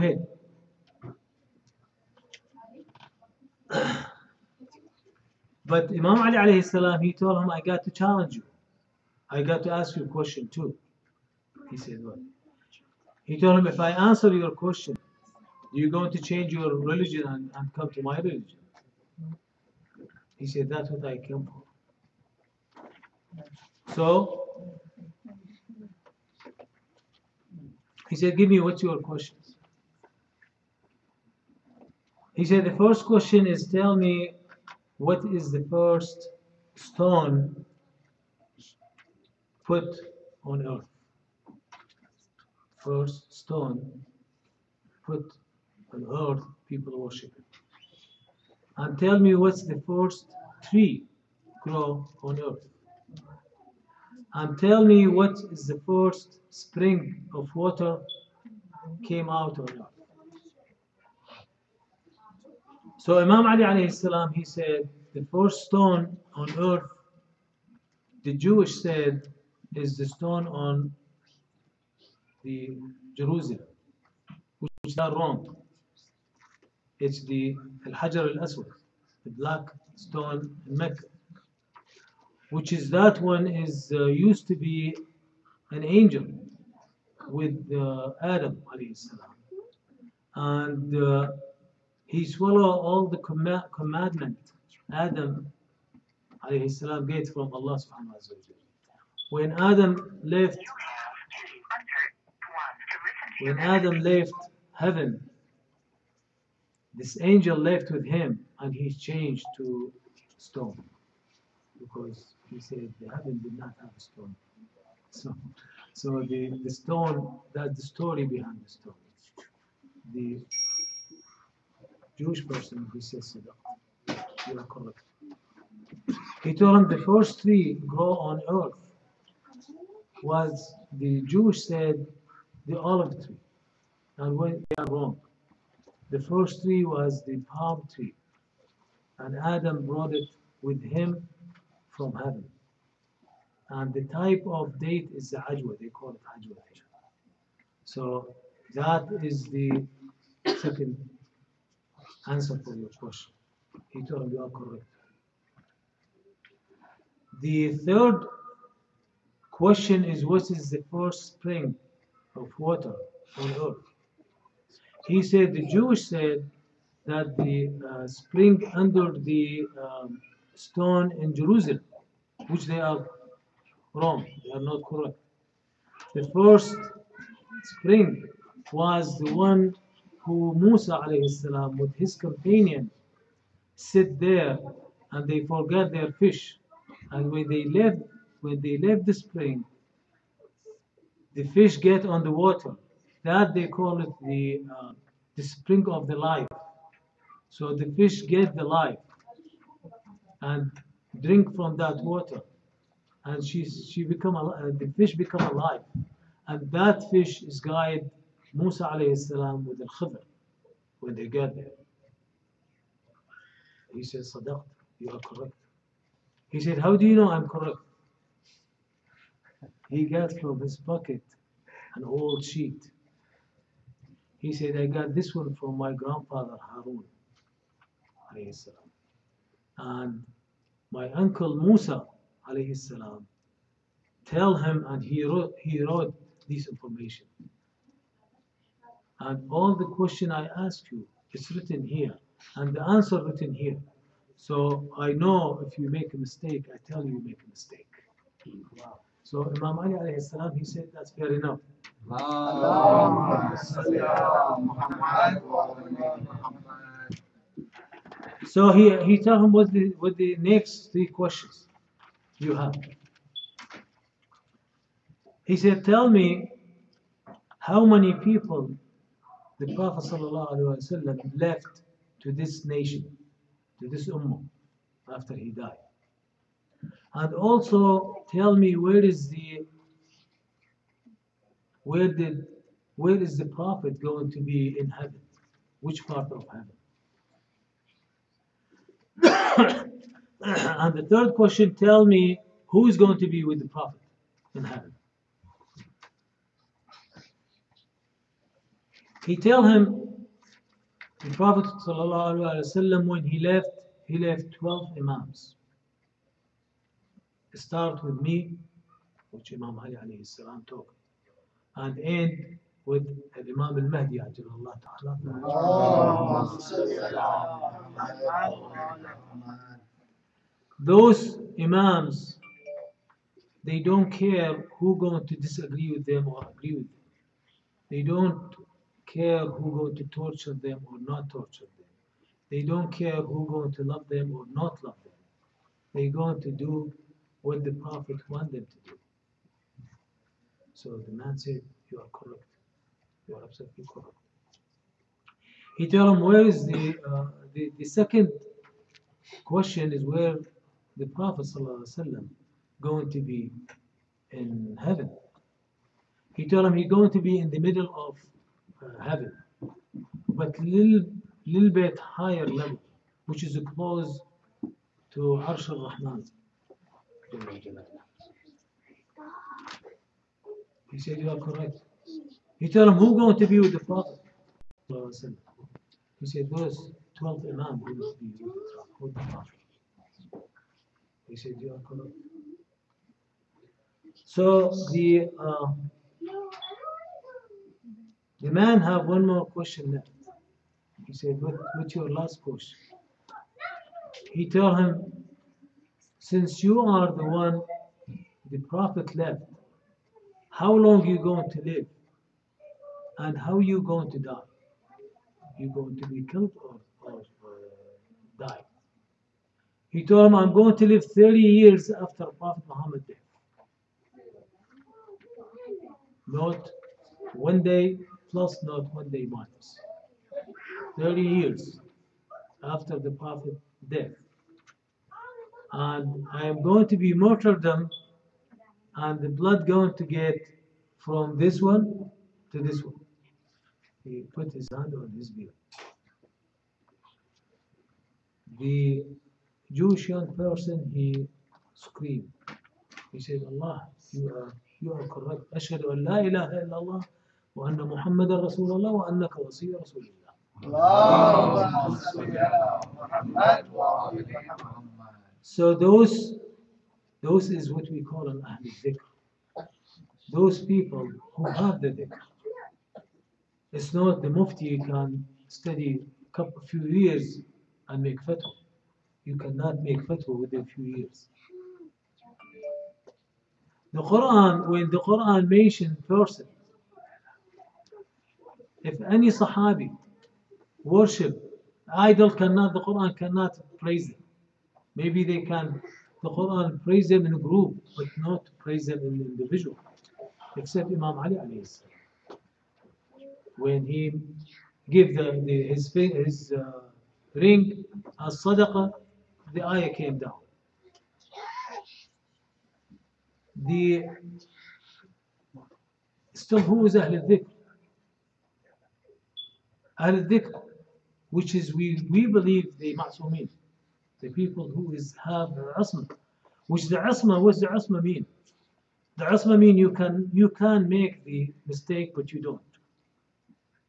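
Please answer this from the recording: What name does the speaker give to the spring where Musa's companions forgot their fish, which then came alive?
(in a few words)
The spring of the life.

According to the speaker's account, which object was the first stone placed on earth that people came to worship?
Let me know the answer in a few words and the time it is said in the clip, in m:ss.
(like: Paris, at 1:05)
Al-Hajar al-Aswad, at 1:17.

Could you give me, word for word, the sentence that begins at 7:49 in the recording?
You cannot make fatwa within a few years.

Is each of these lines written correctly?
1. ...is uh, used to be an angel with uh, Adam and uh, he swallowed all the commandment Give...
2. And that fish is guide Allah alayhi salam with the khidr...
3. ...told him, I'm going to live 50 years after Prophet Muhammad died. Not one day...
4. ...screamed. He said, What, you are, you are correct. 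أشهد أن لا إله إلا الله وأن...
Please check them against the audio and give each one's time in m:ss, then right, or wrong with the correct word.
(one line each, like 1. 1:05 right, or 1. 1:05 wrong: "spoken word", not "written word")
1. 1:23 wrong: "Adam", not "Give"
2. 3:26 wrong: "Musa", not "Allah"
3. 6:50 wrong: "30", not "50"
4. 7:21 wrong: "Allah", not "What".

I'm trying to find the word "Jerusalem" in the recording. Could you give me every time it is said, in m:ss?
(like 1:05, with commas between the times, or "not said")
1:13, 2:51.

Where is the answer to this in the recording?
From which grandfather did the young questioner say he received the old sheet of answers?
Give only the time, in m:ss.
3:46.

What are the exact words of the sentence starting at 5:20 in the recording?
Those Imams, they don't care who going to disagree with them or agree with them.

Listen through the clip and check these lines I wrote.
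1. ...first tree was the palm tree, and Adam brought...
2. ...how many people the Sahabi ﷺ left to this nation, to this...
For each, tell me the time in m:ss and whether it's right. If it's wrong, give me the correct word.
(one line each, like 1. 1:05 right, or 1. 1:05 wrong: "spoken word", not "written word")
1. 2:16 right
2. 4:27 wrong: "Prophet", not "Sahabi".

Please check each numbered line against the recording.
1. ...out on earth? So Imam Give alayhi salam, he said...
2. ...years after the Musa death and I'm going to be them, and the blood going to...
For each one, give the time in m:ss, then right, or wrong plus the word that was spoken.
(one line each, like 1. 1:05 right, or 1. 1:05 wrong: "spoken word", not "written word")
1. 0:59 wrong: "Ali", not "Give"
2. 7:01 wrong: "Prophet", not "Musa".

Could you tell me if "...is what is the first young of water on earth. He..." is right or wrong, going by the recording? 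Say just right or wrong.
wrong.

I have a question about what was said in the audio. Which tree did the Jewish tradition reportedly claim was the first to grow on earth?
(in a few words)
Olive tree.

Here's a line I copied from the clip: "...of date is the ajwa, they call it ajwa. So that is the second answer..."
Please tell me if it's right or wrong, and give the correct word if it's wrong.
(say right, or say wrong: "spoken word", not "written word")
right.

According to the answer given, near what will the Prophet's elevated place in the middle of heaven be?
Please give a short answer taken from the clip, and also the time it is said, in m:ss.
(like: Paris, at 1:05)
Arsh al-Rahman, at 6:05.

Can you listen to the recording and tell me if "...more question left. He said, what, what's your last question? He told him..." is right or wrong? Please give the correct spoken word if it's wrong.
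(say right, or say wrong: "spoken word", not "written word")
right.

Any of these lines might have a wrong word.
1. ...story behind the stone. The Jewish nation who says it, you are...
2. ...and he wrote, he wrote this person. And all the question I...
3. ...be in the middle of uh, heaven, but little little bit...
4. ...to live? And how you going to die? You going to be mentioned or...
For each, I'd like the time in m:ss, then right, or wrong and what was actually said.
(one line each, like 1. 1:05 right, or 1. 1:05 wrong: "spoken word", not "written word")
1. 1:57 wrong: "person", not "nation"
2. 3:54 wrong: "information", not "person"
3. 5:57 right
4. 6:41 wrong: "killed", not "mentioned".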